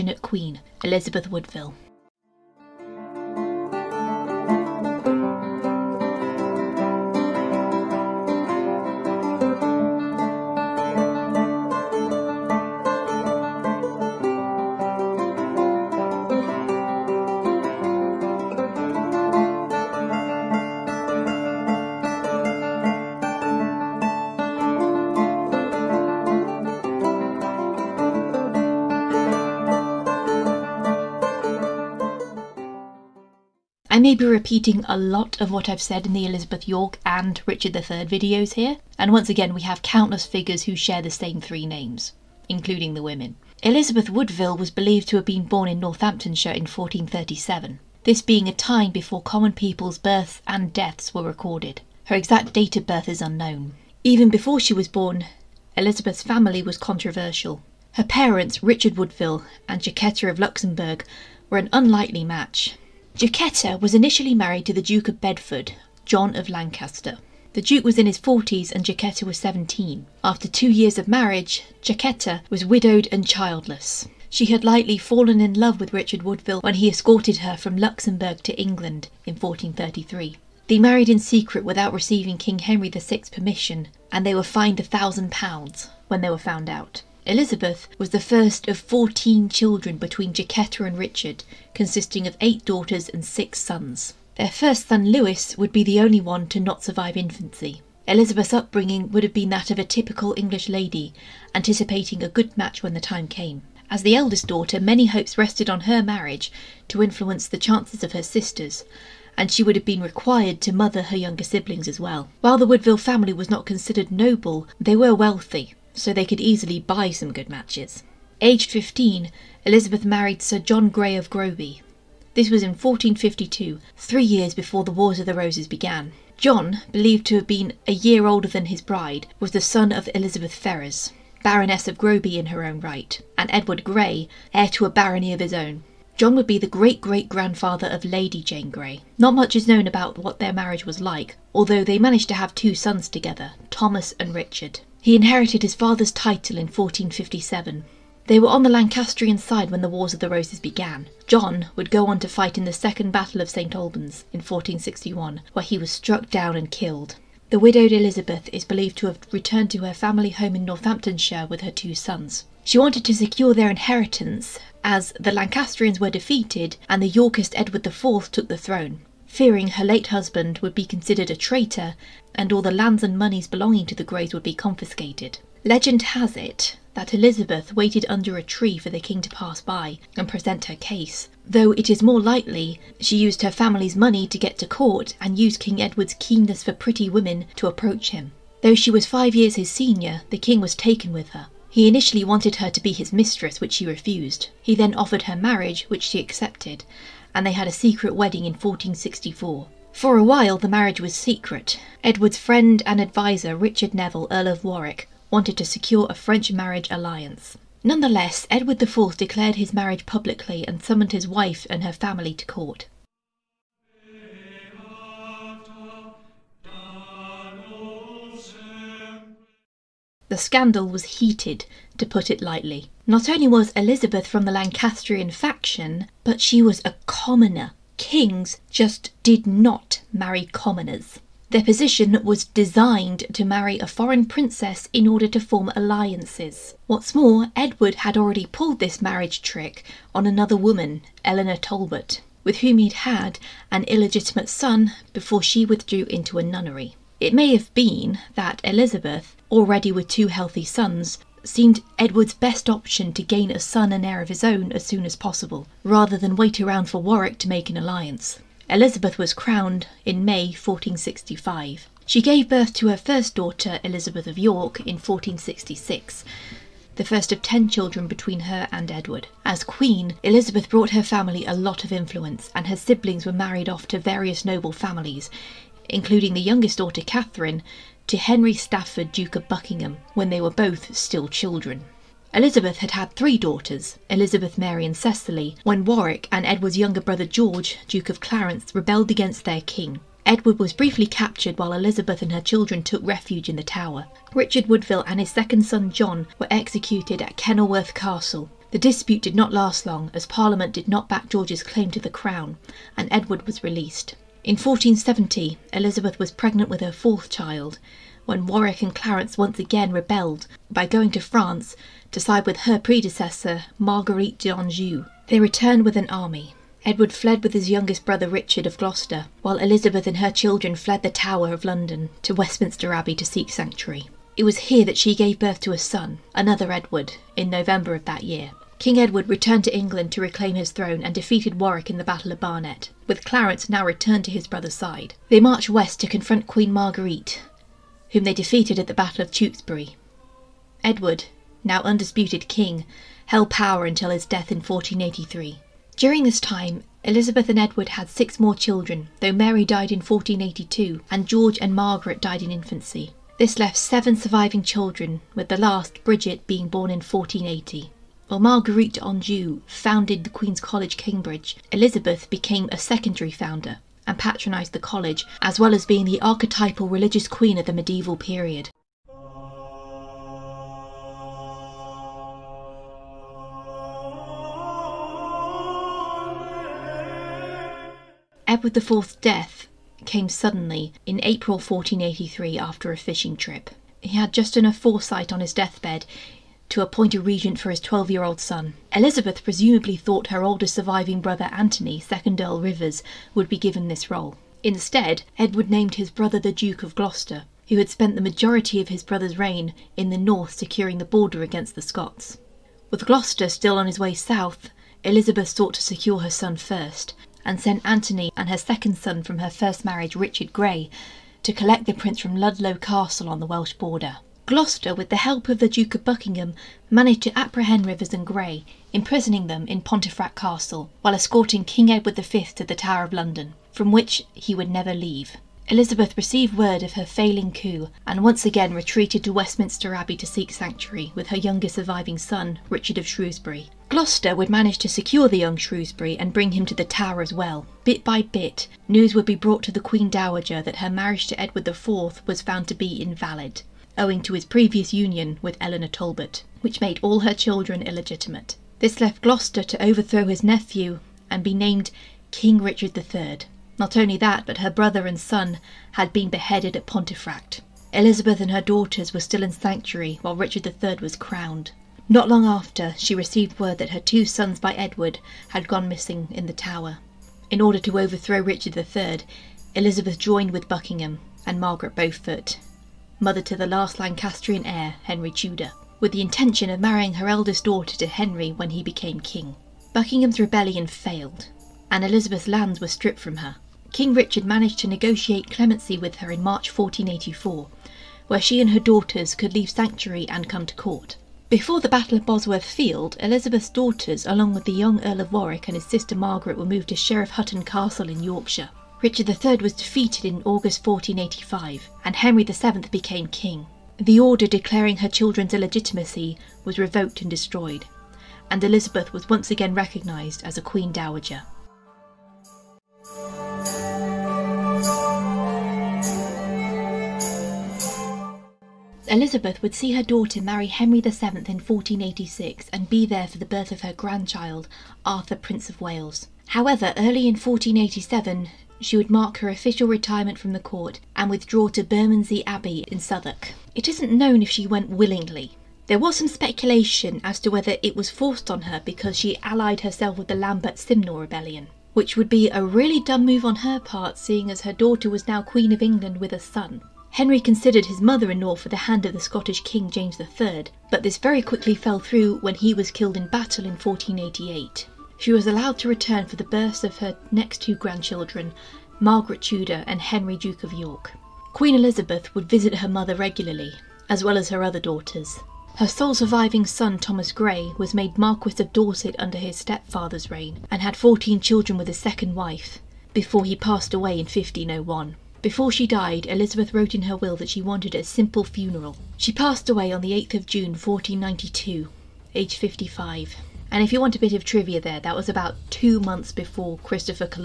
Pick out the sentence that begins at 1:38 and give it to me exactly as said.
Elizabeth's upbringing would have been that of a typical English lady, anticipating a good match when the time came.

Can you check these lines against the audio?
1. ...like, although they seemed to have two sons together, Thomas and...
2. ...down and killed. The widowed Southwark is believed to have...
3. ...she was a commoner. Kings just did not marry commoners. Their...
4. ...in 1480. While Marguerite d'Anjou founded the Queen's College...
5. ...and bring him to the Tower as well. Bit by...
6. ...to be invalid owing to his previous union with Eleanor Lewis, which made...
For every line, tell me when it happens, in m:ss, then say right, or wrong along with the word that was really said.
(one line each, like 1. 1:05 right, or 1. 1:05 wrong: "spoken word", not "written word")
1. 2:21 wrong: "managed", not "seemed"
2. 2:36 wrong: "Elizabeth", not "Southwark"
3. 3:46 right
4. 5:56 right
5. 7:16 right
6. 7:22 wrong: "Talbot", not "Lewis".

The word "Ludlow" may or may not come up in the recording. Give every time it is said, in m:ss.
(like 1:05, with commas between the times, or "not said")
6:52.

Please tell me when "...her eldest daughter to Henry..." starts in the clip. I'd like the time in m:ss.
7:57.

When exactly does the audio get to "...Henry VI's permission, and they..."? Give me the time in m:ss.
1:22.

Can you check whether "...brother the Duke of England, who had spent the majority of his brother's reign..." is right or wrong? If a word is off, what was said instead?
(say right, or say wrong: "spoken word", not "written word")
wrong: "Gloucester", not "England".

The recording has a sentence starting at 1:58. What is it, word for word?
Aged 15, Elizabeth married Sir John Grey of Groby.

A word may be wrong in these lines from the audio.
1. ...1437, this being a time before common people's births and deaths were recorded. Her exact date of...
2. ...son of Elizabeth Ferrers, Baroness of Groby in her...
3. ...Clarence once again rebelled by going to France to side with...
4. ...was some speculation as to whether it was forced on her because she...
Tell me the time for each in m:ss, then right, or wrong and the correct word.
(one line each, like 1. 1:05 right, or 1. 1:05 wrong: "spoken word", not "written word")
1. 0:46 right
2. 2:09 right
3. 5:08 right
4. 8:55 right.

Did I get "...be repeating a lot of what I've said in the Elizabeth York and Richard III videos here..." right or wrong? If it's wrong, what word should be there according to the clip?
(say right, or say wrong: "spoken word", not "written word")
right.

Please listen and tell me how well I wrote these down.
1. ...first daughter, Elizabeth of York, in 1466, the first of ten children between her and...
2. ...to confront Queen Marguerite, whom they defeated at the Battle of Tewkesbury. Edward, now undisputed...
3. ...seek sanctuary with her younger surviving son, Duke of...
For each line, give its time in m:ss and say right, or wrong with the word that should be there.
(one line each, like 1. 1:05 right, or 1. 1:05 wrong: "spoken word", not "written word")
1. 4:22 right
2. 5:36 right
3. 7:10 wrong: "Richard", not "Duke".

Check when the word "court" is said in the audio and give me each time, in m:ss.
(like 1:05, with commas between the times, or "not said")
3:04, 3:32, 8:10, 8:50.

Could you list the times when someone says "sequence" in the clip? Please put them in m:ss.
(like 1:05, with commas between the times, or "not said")
not said.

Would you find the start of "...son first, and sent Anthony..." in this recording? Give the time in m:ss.
6:46.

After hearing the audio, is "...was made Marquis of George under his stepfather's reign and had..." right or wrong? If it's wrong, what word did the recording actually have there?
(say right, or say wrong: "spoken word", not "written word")
wrong: "Dorset", not "George".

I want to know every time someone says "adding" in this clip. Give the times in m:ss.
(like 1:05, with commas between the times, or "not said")
not said.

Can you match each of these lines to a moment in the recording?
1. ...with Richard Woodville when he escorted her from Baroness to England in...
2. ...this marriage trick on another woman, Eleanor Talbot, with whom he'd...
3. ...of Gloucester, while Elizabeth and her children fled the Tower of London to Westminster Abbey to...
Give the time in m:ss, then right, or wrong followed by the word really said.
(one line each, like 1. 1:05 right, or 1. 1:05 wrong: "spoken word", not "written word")
1. 1:15 wrong: "Luxembourg", not "Baroness"
2. 3:58 right
3. 5:18 right.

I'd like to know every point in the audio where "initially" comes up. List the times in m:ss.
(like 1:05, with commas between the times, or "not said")
1:03, 3:11.